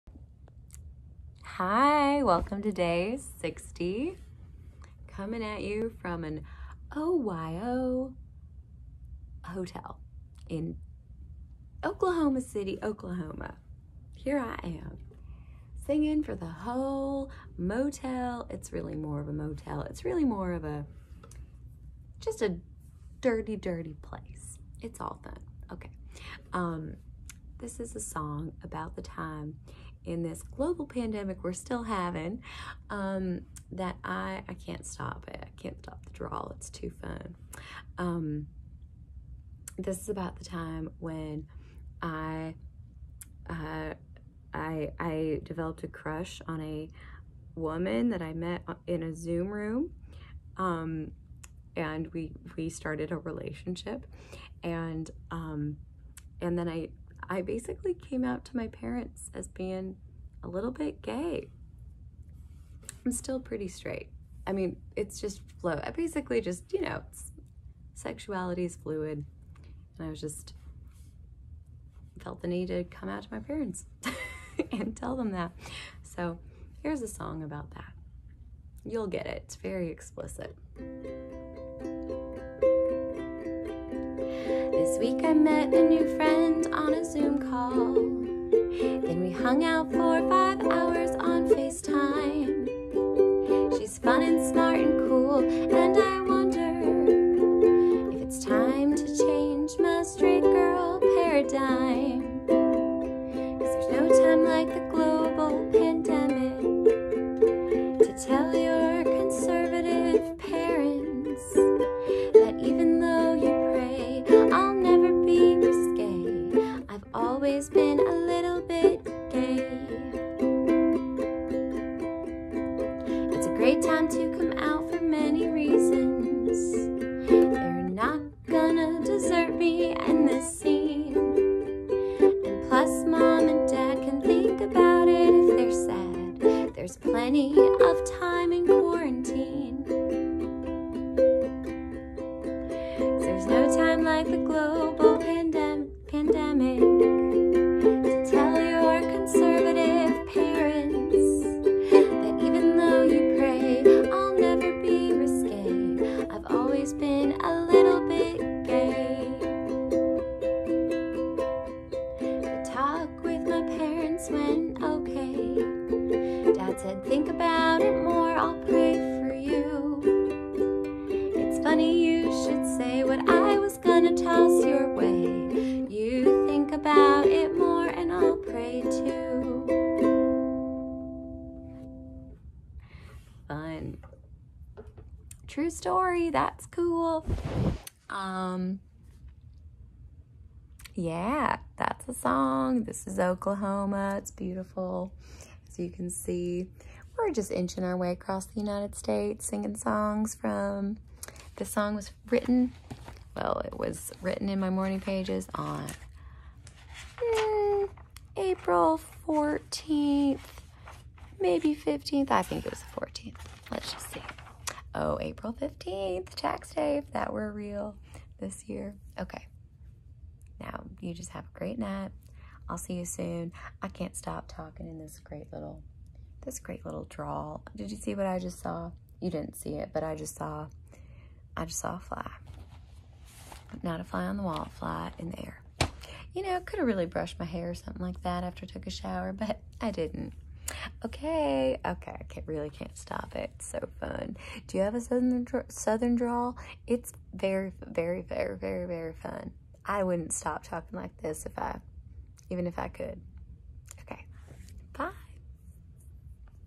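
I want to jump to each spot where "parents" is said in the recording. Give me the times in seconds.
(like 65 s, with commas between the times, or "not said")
58 s, 73 s.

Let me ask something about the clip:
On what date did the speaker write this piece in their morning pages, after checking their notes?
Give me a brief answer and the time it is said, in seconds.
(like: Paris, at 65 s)
April 15th, at 215 s.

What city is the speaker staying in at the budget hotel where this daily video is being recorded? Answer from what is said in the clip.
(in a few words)
Oklahoma City.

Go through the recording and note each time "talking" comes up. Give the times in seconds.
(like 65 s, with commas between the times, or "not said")
224 s, 250 s.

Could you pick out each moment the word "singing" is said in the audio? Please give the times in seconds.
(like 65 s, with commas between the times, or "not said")
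15 s, 199 s.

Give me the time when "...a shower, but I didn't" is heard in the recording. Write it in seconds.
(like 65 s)
238 s.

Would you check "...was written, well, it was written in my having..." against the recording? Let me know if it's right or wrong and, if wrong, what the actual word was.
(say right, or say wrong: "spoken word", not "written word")
wrong: "morning", not "having".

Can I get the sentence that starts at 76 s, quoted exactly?
So here's a song about that.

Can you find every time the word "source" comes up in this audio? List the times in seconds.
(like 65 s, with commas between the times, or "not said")
not said.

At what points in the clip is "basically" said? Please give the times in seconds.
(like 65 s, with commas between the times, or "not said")
57 s, 65 s.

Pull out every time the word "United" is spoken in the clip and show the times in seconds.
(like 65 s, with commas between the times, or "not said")
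198 s.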